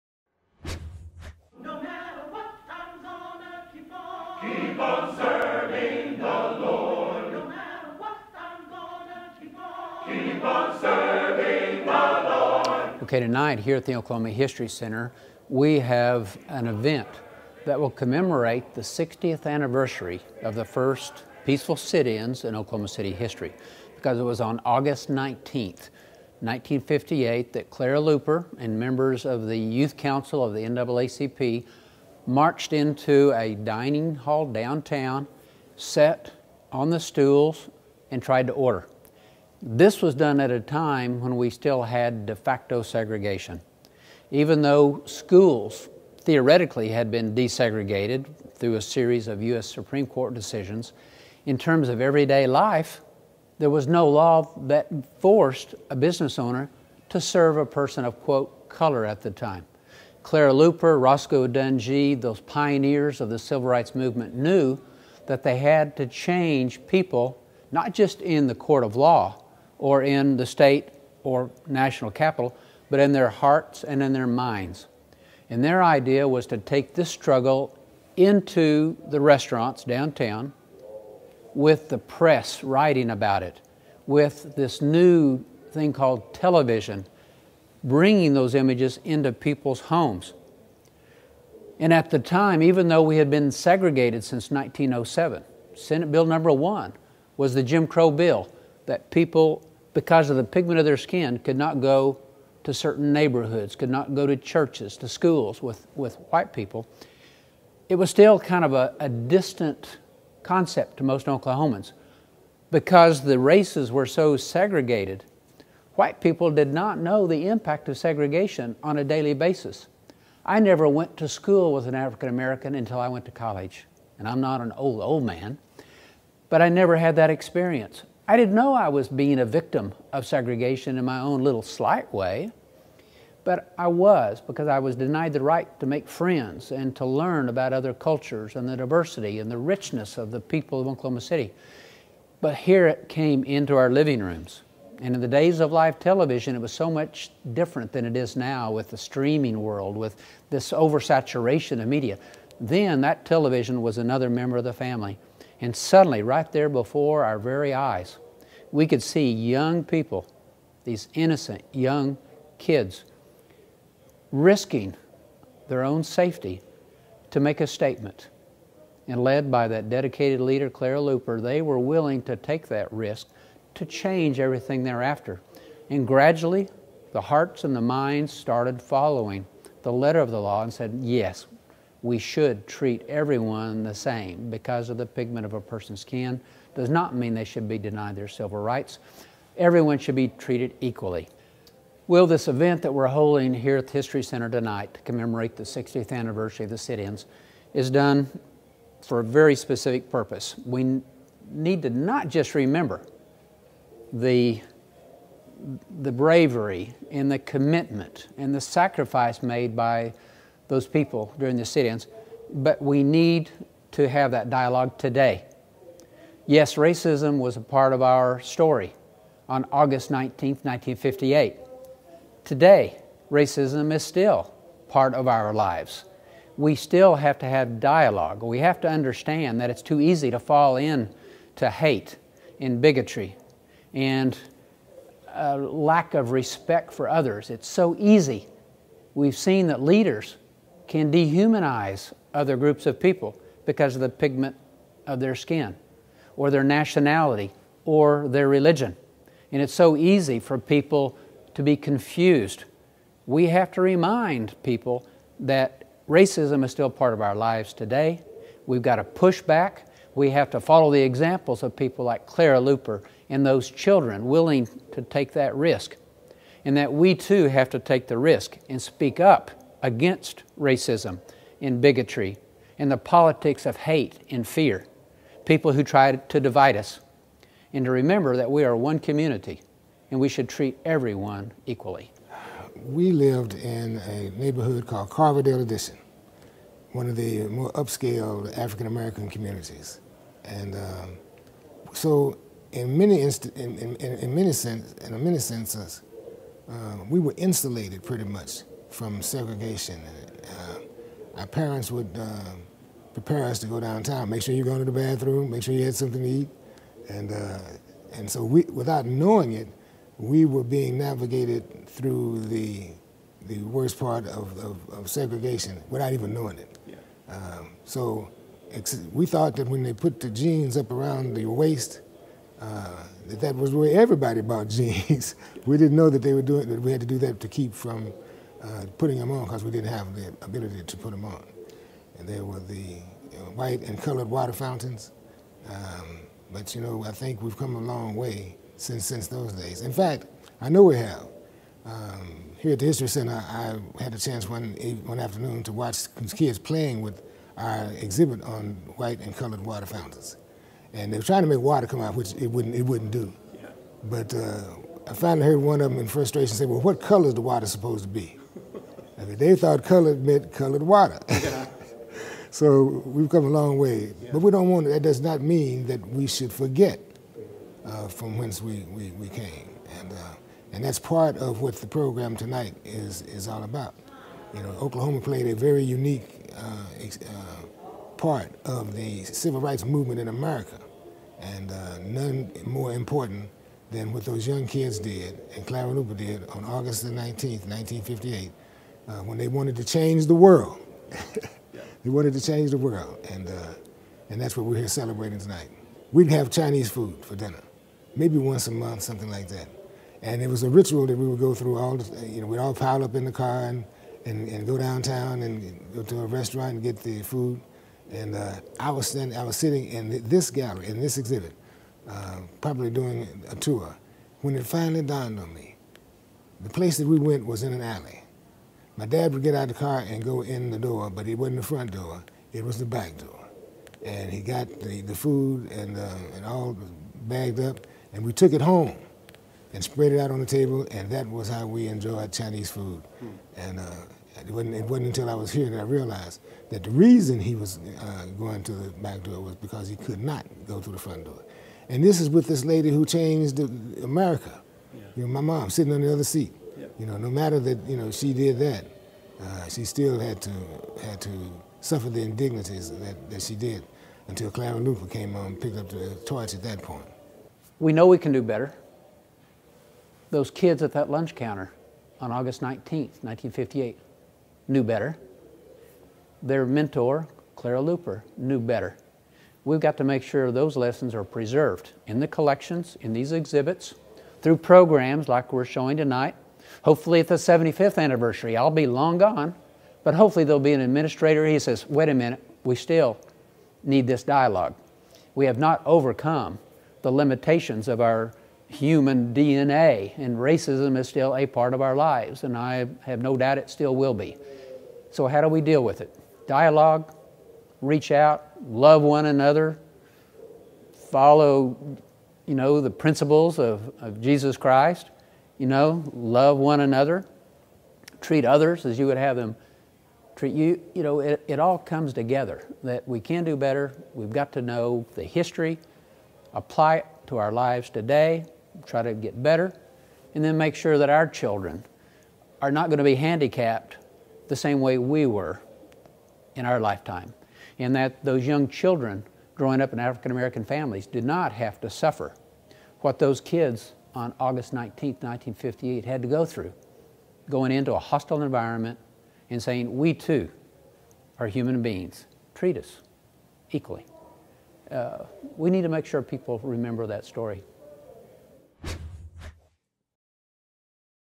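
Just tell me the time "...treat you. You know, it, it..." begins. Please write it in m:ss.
8:30.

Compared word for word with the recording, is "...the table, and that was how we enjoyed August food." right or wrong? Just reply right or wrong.
wrong.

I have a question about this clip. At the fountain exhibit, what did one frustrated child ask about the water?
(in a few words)
What color is the water supposed to be?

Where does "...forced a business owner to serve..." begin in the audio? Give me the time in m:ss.
0:55.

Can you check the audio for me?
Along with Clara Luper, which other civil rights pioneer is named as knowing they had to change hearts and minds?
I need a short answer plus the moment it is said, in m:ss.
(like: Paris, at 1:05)
Roscoe Dunjee, at 1:01.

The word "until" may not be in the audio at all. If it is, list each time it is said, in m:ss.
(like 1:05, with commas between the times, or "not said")
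2:02, 7:15, 7:34.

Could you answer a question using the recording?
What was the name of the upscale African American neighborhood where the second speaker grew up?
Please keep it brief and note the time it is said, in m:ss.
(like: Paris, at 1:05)
Carverdale Addition, at 4:45.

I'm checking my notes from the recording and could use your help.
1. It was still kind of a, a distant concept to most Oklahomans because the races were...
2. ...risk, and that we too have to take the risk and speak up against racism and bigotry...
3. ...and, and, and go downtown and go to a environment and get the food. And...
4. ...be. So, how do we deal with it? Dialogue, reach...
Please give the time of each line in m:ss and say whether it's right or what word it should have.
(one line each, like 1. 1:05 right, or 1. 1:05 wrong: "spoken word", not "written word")
1. 1:47 right
2. 4:25 right
3. 6:43 wrong: "restaurant", not "environment"
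4. 8:14 right.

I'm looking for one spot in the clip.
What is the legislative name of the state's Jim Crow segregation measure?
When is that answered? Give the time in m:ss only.
1:35.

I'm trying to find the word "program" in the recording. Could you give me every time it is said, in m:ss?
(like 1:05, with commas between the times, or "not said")
6:11, 7:54.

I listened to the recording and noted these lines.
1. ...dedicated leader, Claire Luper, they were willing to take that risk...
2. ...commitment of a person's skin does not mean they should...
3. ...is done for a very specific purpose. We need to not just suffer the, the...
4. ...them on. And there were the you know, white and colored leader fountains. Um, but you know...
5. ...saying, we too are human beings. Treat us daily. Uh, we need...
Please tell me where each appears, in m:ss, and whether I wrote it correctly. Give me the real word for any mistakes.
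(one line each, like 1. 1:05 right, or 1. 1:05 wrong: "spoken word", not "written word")
1. 2:49 right
2. 3:05 wrong: "pigment", not "commitment"
3. 3:17 wrong: "remember", not "suffer"
4. 5:31 wrong: "water", not "leader"
5. 8:59 wrong: "equally", not "daily".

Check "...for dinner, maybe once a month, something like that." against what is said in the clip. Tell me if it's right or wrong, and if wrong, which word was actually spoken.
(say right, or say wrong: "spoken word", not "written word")
right.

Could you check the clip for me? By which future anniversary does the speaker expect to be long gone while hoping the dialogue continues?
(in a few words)
75th anniversary.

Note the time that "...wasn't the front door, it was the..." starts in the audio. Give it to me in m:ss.
7:01.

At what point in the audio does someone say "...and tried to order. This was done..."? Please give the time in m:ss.
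0:38.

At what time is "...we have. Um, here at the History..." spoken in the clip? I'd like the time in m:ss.
5:40.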